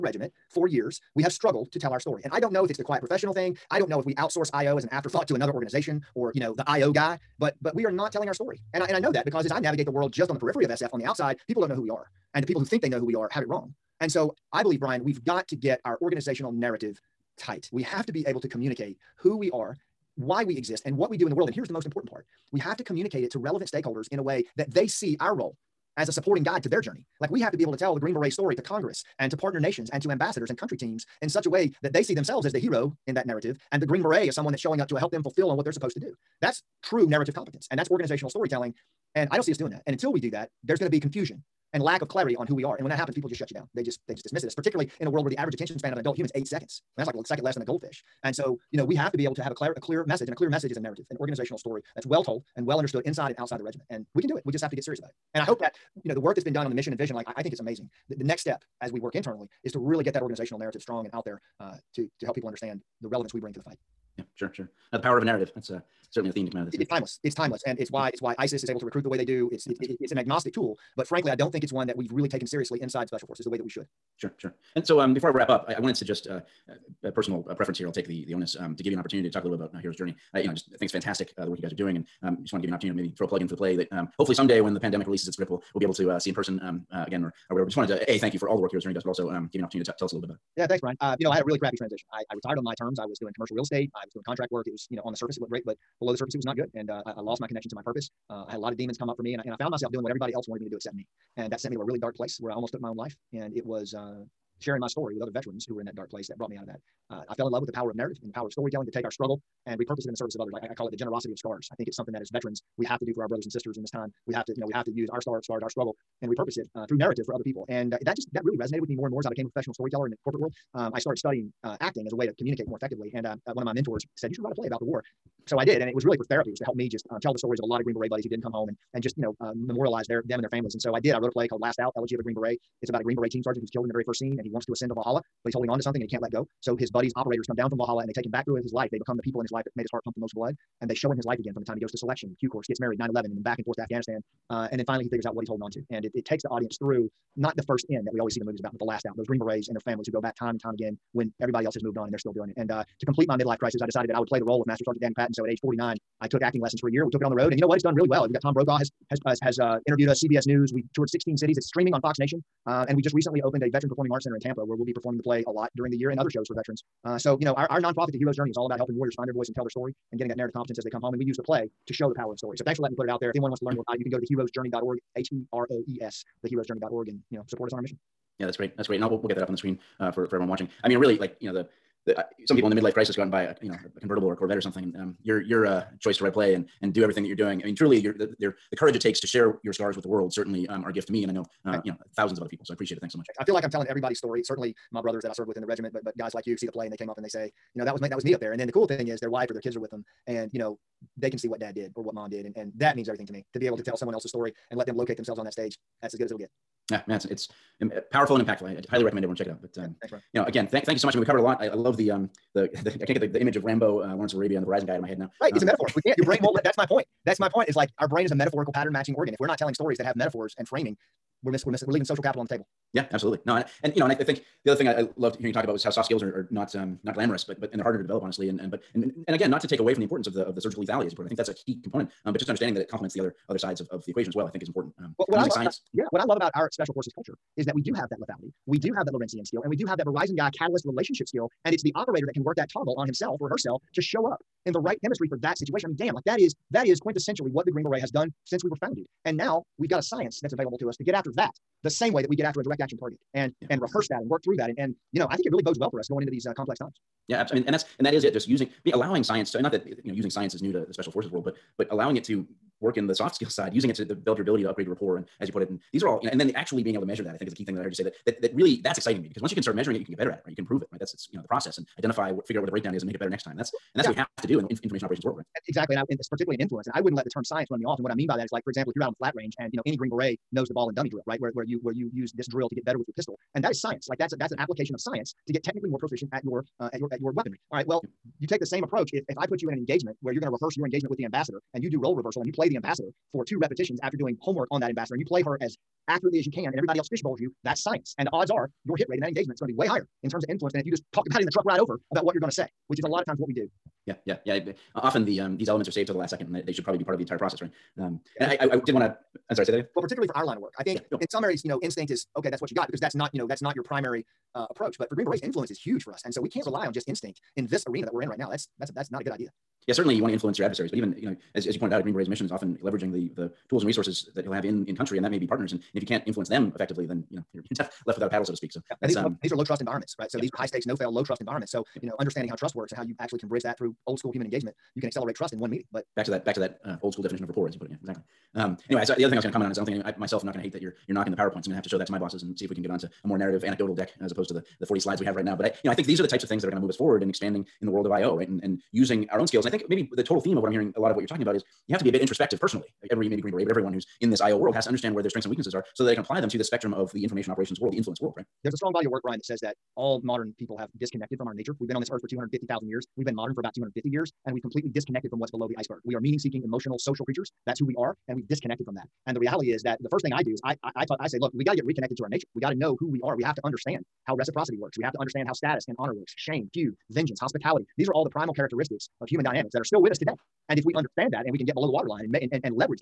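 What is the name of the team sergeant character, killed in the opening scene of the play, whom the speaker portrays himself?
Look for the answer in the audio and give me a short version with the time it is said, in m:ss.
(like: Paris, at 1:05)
Danny Patton, at 2:34.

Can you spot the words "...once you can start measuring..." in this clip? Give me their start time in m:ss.
4:29.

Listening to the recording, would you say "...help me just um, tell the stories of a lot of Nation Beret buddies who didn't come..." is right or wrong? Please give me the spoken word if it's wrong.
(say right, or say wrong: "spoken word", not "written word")
wrong: "Green", not "Nation".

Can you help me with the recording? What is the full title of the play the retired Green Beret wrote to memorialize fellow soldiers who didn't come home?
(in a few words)
Last Out: Elegy of a Green Beret.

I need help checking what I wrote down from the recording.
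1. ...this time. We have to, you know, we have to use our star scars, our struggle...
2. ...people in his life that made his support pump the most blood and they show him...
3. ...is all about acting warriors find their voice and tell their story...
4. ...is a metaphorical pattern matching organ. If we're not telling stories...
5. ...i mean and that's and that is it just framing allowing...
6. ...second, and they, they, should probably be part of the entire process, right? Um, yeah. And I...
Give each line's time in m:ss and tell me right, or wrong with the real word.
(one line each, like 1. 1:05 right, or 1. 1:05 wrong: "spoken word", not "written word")
1. 1:53 right
2. 2:19 wrong: "heart", not "support"
3. 2:48 wrong: "helping", not "acting"
4. 3:38 right
5. 4:17 wrong: "using", not "framing"
6. 5:06 right.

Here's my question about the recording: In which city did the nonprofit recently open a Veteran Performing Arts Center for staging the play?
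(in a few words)
Tampa.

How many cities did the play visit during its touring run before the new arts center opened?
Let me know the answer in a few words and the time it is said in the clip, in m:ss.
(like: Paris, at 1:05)
16, at 2:41.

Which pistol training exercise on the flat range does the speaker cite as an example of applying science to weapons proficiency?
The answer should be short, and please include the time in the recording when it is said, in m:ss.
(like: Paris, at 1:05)
ball and dummy drill, at 4:40.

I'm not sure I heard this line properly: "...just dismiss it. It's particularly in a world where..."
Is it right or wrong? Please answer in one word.
right.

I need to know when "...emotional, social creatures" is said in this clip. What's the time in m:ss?
6:06.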